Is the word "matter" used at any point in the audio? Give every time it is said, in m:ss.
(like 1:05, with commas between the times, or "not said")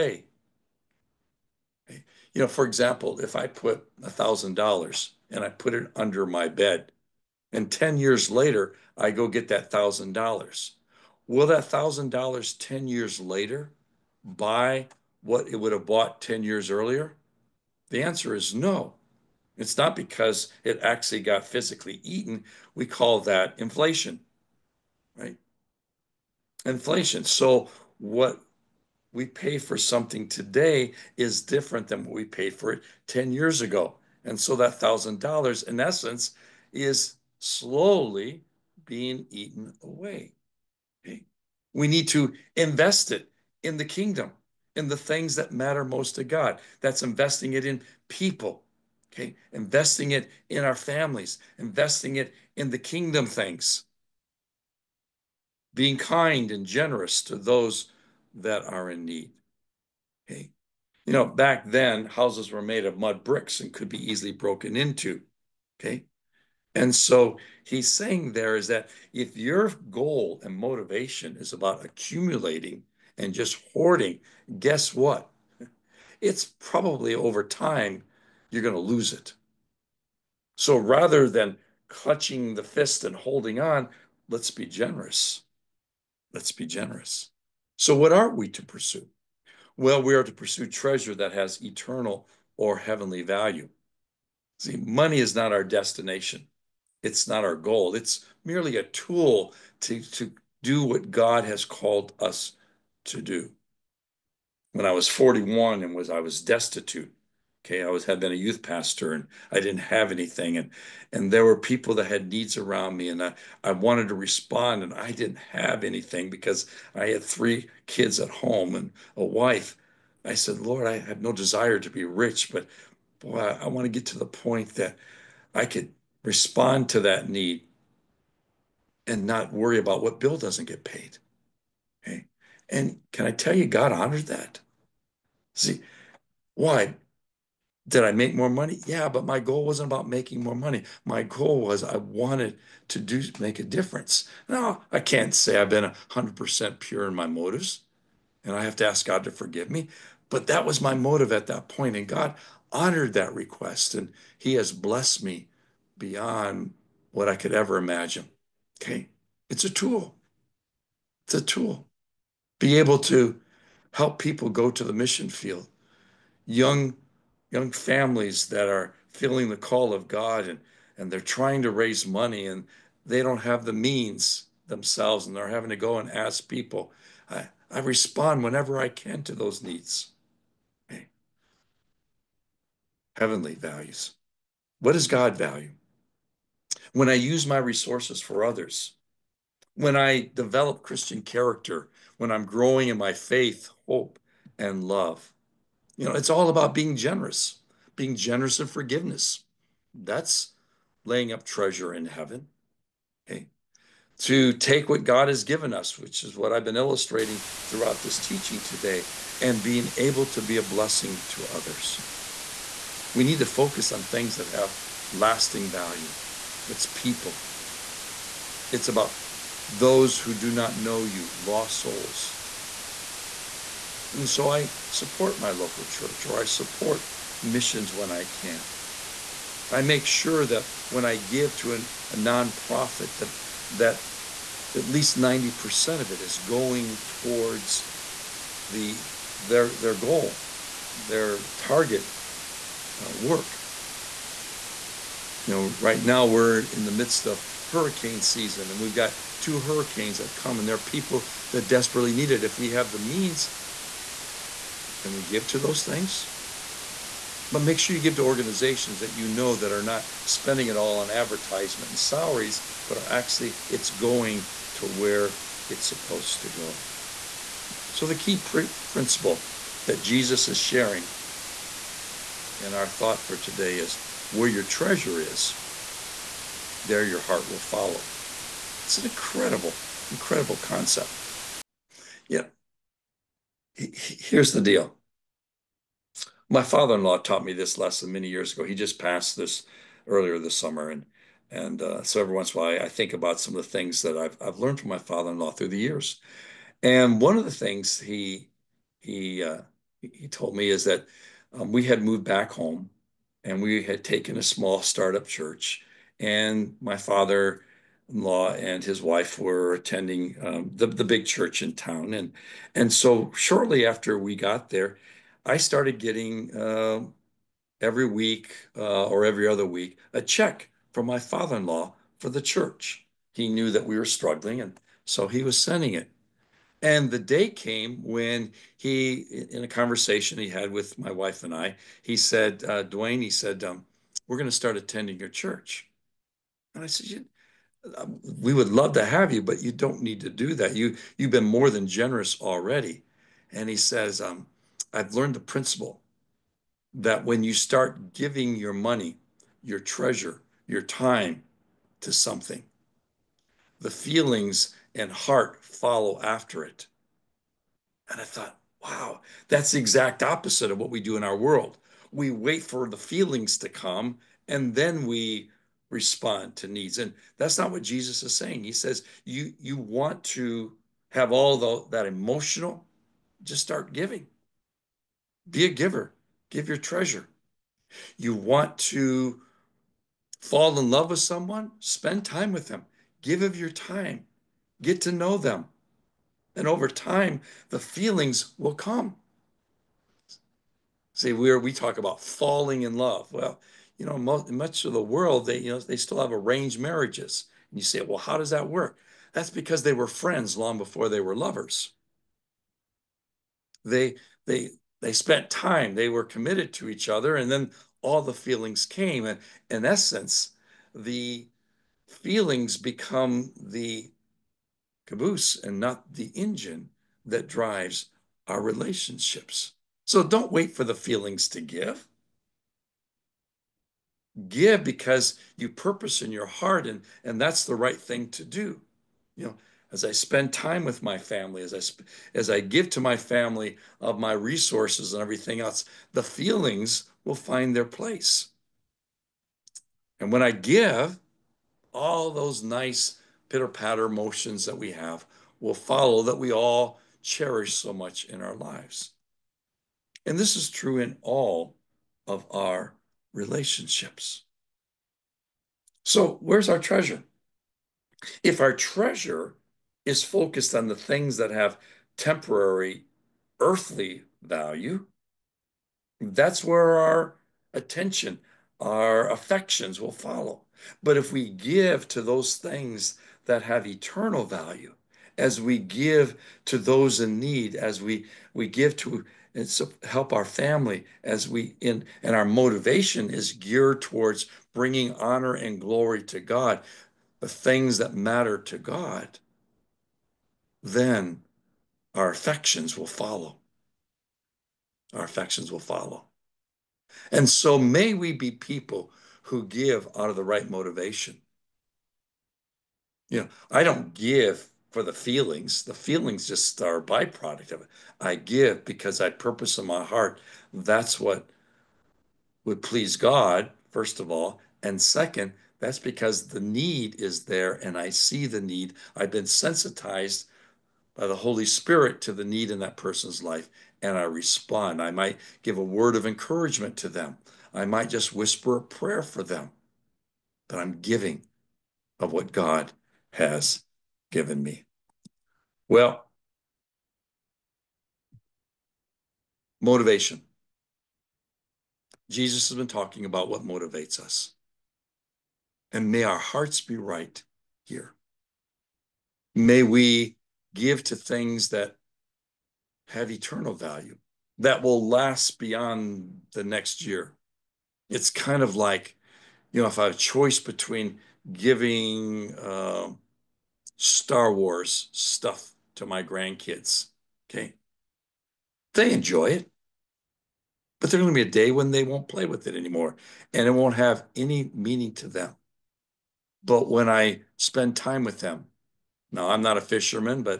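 0:45, 8:08.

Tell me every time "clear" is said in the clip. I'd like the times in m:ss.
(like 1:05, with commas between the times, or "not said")
not said.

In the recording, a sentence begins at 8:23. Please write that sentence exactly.
You know, I don't give for the feelings.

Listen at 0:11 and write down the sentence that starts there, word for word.
Will that $1,000 10 years later buy what it would have bought 10 years earlier?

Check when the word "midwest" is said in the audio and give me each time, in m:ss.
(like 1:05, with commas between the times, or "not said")
not said.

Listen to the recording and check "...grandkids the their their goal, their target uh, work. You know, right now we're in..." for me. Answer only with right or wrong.
wrong.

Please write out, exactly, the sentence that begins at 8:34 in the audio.
And second, that's because the need is there and I see the need.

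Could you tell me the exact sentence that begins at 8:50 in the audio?
But I'm giving of what God has given me.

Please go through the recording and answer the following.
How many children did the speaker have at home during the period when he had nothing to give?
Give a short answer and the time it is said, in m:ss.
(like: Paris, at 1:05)
3, at 1:57.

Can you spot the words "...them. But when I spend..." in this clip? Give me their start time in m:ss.
9:35.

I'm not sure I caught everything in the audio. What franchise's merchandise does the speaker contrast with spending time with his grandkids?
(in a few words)
Star Wars.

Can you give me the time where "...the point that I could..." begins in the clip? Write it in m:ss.
2:04.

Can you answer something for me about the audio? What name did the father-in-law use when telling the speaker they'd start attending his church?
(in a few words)
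Duane.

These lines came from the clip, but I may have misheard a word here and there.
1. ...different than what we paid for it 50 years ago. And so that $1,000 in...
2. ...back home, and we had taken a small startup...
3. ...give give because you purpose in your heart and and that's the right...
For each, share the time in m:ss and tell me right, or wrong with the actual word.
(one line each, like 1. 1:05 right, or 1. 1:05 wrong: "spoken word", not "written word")
1. 0:31 wrong: "10", not "50"
2. 5:02 right
3. 7:01 right.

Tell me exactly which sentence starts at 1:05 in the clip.
Okay, and so he's saying there is that if your goal and motivation is about accumulating and just hoarding, guess what?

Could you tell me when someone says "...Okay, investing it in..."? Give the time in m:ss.
0:49.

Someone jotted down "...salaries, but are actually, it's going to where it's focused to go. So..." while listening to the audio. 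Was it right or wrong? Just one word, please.
wrong.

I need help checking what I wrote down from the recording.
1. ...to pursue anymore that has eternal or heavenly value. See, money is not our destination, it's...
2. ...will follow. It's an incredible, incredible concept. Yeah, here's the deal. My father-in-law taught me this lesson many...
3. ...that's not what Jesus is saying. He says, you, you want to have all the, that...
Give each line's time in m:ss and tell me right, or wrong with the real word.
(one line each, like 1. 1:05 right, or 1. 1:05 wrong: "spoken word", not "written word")
1. 1:30 wrong: "treasure", not "anymore"
2. 4:37 right
3. 6:07 right.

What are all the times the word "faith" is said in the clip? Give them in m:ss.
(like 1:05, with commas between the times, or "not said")
3:13.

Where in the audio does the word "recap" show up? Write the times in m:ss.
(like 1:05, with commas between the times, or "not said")
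not said.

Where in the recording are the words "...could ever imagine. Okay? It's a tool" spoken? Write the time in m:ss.
2:37.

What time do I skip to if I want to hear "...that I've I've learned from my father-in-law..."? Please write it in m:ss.
4:54.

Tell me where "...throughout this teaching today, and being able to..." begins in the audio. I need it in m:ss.
3:27.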